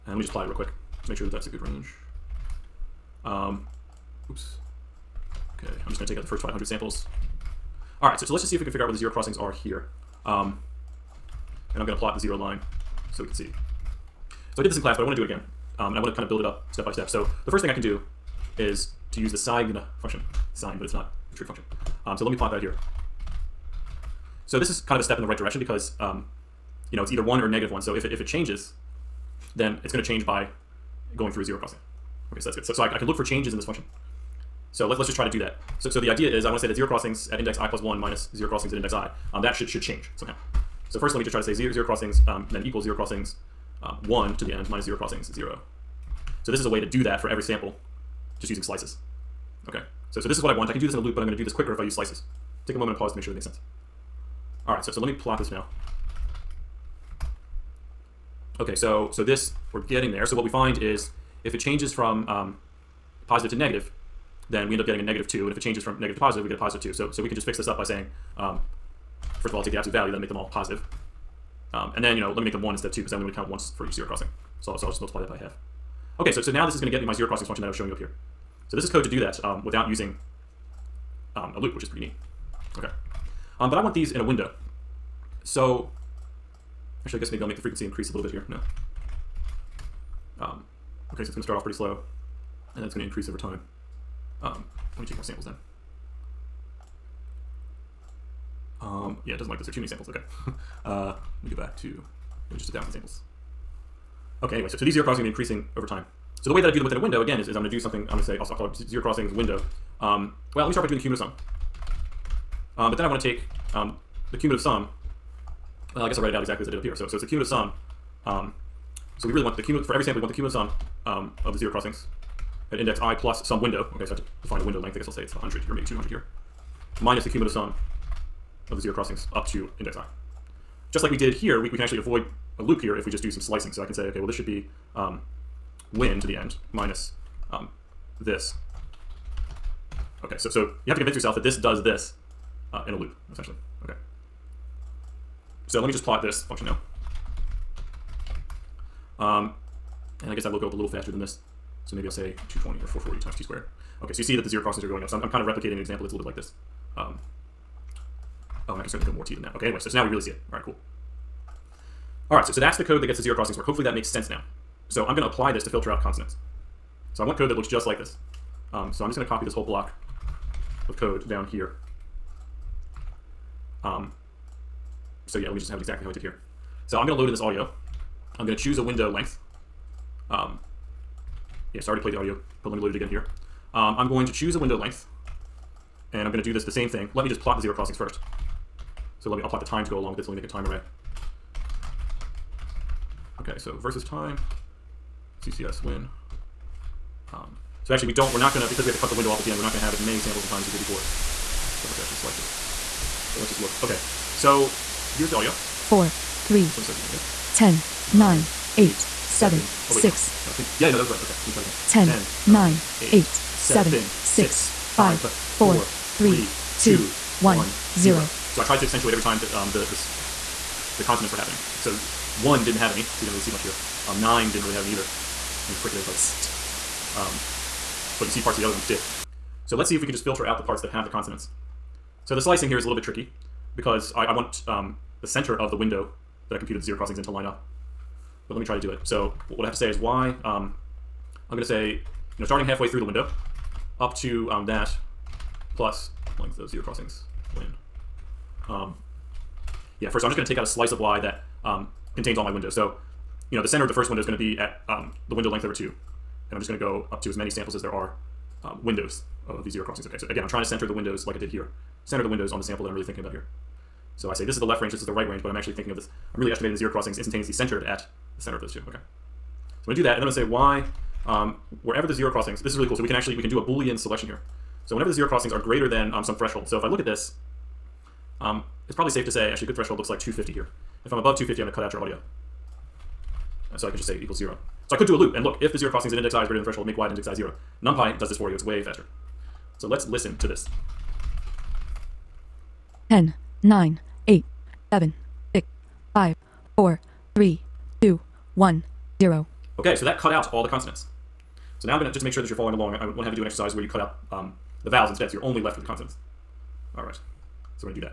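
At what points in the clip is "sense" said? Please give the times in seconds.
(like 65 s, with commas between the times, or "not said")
53 s, 164 s.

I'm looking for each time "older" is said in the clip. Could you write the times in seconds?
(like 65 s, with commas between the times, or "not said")
not said.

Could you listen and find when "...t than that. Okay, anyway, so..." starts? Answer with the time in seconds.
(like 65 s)
159 s.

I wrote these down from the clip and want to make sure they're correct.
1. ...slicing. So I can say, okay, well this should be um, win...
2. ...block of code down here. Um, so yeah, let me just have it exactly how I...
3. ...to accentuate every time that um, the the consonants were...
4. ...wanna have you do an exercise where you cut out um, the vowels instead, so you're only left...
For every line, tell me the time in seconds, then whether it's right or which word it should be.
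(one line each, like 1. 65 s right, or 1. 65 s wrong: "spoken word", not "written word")
1. 133 s right
2. 169 s right
3. 218 s right
4. 303 s right.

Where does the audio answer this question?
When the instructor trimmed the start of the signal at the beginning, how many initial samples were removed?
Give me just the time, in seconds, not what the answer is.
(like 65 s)
6 s.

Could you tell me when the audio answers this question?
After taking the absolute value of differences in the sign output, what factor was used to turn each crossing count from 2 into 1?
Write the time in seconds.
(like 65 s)
75 s.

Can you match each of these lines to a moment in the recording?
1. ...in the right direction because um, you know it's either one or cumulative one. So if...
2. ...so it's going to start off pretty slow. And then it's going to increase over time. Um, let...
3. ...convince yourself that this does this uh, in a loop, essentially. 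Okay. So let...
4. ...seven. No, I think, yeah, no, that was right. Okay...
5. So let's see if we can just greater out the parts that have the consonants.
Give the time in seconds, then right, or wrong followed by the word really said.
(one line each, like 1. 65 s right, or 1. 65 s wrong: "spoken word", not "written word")
1. 25 s wrong: "negative", not "cumulative"
2. 91 s right
3. 140 s right
4. 210 s wrong: "six", not "seven"
5. 229 s wrong: "filter", not "greater".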